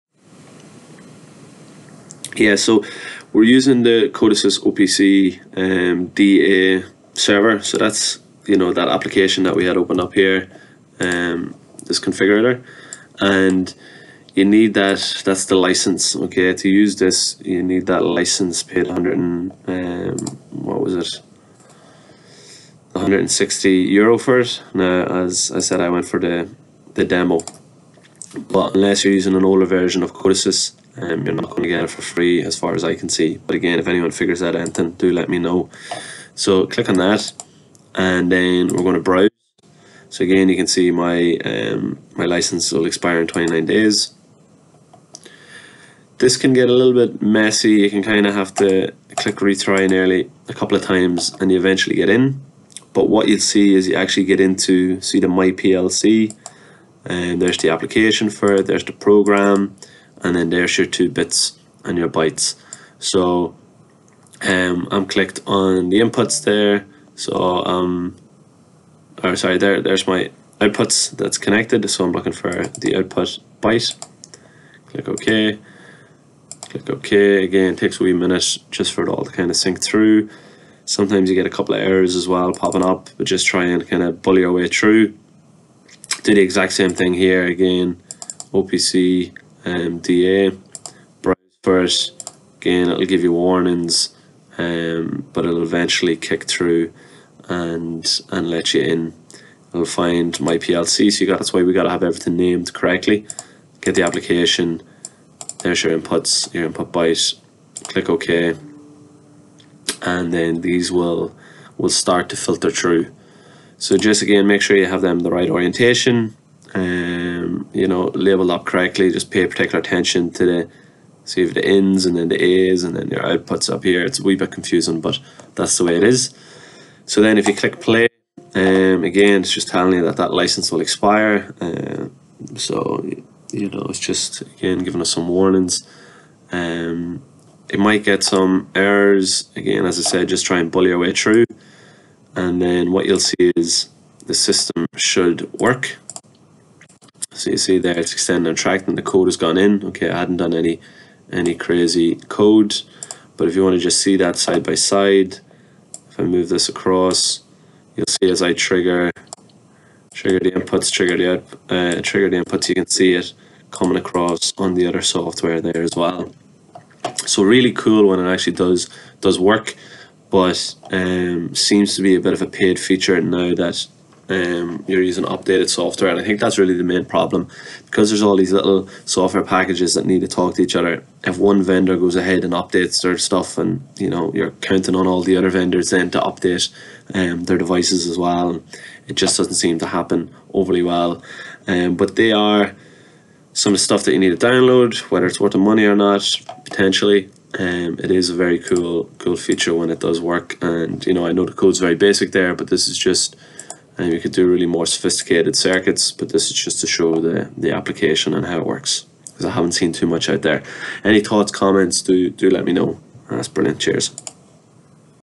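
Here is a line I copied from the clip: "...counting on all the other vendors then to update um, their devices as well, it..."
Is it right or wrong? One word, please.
right.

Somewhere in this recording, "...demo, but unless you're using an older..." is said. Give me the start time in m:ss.
0:27.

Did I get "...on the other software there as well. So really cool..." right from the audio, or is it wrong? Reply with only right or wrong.
right.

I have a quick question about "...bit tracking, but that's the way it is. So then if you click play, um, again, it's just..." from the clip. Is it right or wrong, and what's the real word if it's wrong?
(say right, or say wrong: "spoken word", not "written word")
wrong: "confusing", not "tracking".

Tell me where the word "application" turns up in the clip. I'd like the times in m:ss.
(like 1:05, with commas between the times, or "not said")
0:08, 0:57, 1:44, 3:27.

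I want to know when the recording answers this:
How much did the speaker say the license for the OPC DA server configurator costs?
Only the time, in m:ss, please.
0:22.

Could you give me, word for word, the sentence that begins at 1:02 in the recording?
So um, I'm clicked on the inputs there.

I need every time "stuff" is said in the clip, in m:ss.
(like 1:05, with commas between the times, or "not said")
3:03, 3:13.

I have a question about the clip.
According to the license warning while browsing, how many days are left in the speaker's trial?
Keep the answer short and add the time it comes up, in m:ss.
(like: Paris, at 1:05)
29 days, at 0:43.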